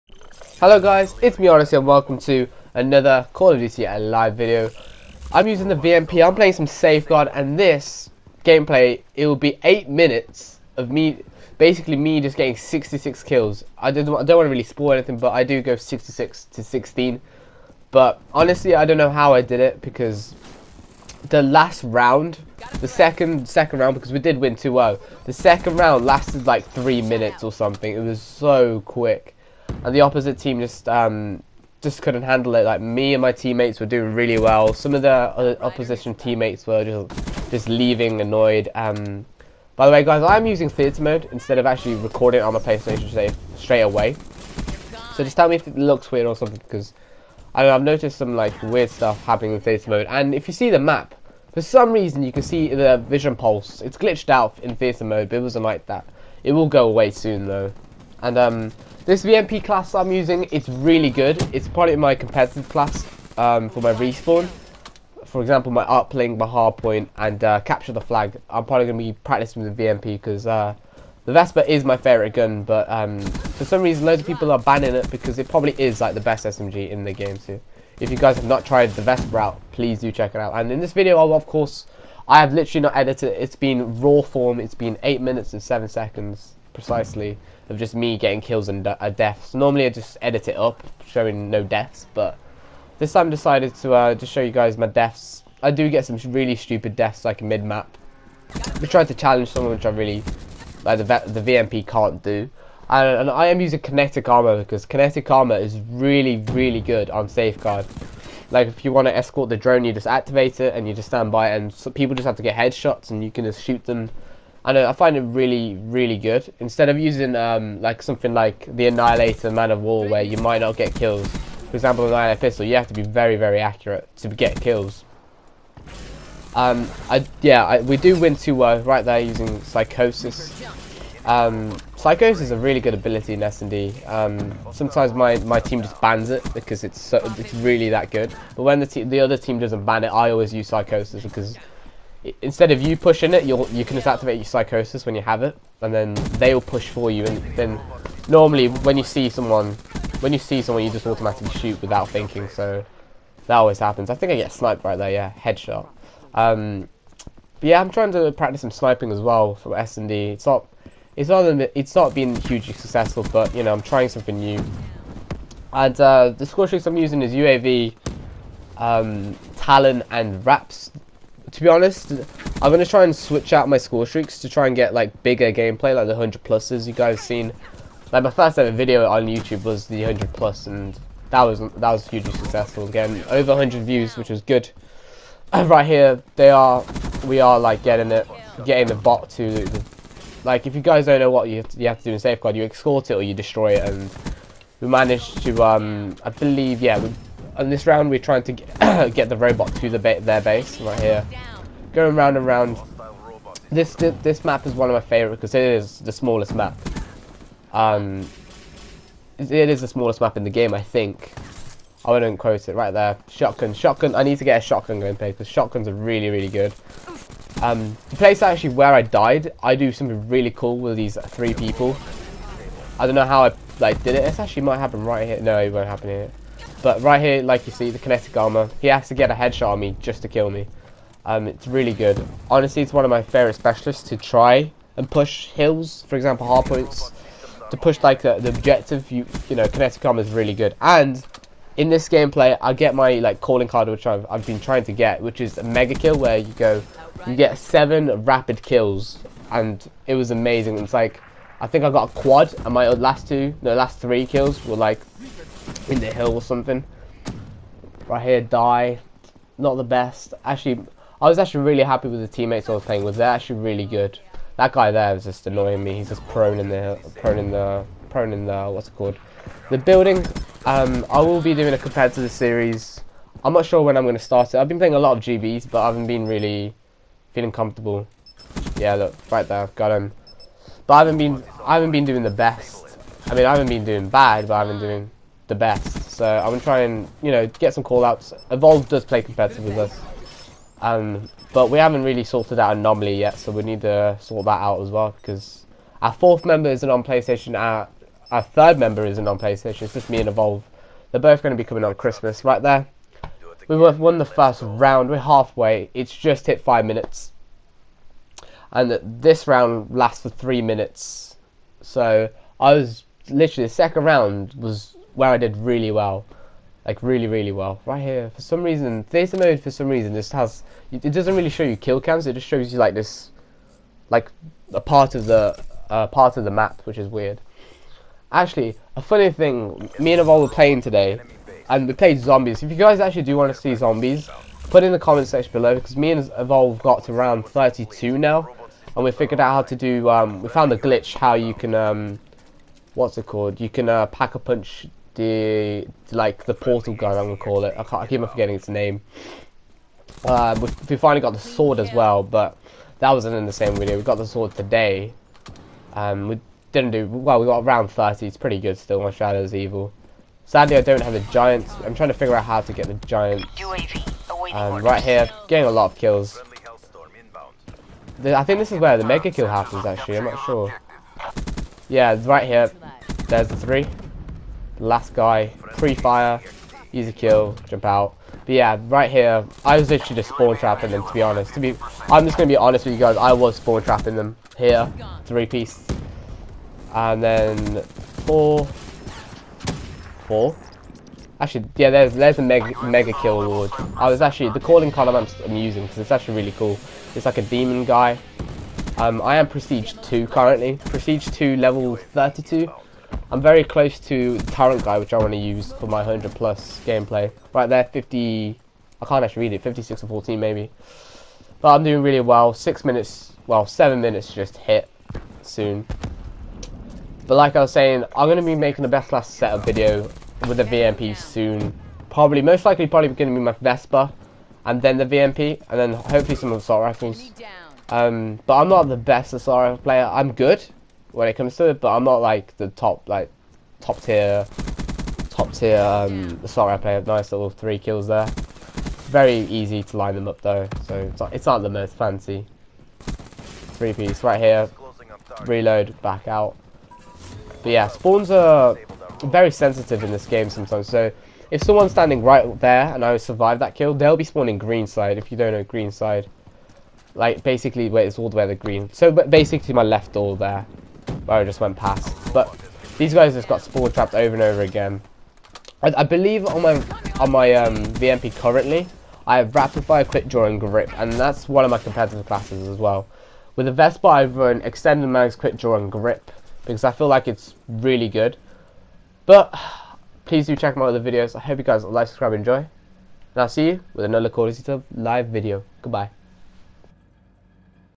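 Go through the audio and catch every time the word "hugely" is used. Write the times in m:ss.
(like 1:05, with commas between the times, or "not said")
2:42, 3:02.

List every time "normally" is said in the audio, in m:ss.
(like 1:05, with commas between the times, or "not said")
1:29, 2:28.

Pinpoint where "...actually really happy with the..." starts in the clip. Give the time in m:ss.
4:21.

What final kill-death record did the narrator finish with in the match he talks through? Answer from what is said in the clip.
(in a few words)
66 to 16.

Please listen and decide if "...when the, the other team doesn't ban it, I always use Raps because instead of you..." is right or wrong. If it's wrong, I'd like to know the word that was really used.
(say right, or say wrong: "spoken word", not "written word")
wrong: "Psychosis", not "Raps".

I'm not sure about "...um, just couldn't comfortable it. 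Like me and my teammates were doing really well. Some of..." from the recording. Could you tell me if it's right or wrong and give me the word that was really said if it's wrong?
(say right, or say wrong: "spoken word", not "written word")
wrong: "handle", not "comfortable".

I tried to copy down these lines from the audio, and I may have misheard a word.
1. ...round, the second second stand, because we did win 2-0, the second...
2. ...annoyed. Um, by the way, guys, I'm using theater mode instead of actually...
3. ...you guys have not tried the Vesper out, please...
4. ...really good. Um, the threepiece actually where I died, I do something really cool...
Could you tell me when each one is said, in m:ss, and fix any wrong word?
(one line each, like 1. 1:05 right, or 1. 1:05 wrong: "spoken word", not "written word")
1. 0:21 wrong: "round", not "stand"
2. 0:38 right
3. 1:18 right
4. 3:36 wrong: "place", not "threepiece".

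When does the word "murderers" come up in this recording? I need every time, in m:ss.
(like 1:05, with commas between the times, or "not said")
not said.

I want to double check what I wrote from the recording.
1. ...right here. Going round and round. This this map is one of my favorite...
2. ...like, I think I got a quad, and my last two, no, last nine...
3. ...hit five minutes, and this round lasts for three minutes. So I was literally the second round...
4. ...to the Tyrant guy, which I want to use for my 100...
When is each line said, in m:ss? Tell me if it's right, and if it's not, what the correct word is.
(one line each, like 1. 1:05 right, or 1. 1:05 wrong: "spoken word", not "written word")
1. 3:20 right
2. 4:10 wrong: "three", not "nine"
3. 5:06 right
4. 6:44 right.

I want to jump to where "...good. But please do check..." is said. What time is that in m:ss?
7:58.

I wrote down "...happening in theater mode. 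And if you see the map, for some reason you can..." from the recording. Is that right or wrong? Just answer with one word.
right.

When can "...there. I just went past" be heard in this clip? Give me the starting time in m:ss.
7:40.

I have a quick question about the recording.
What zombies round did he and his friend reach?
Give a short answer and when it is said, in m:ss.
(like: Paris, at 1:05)
32, at 5:37.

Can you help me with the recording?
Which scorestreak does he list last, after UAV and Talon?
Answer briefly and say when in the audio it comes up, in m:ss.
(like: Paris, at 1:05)
Raps, at 2:50.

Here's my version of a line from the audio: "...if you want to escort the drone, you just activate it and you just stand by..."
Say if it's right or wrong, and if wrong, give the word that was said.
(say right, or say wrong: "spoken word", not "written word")
right.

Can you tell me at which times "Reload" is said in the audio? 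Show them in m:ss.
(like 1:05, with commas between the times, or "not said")
7:25.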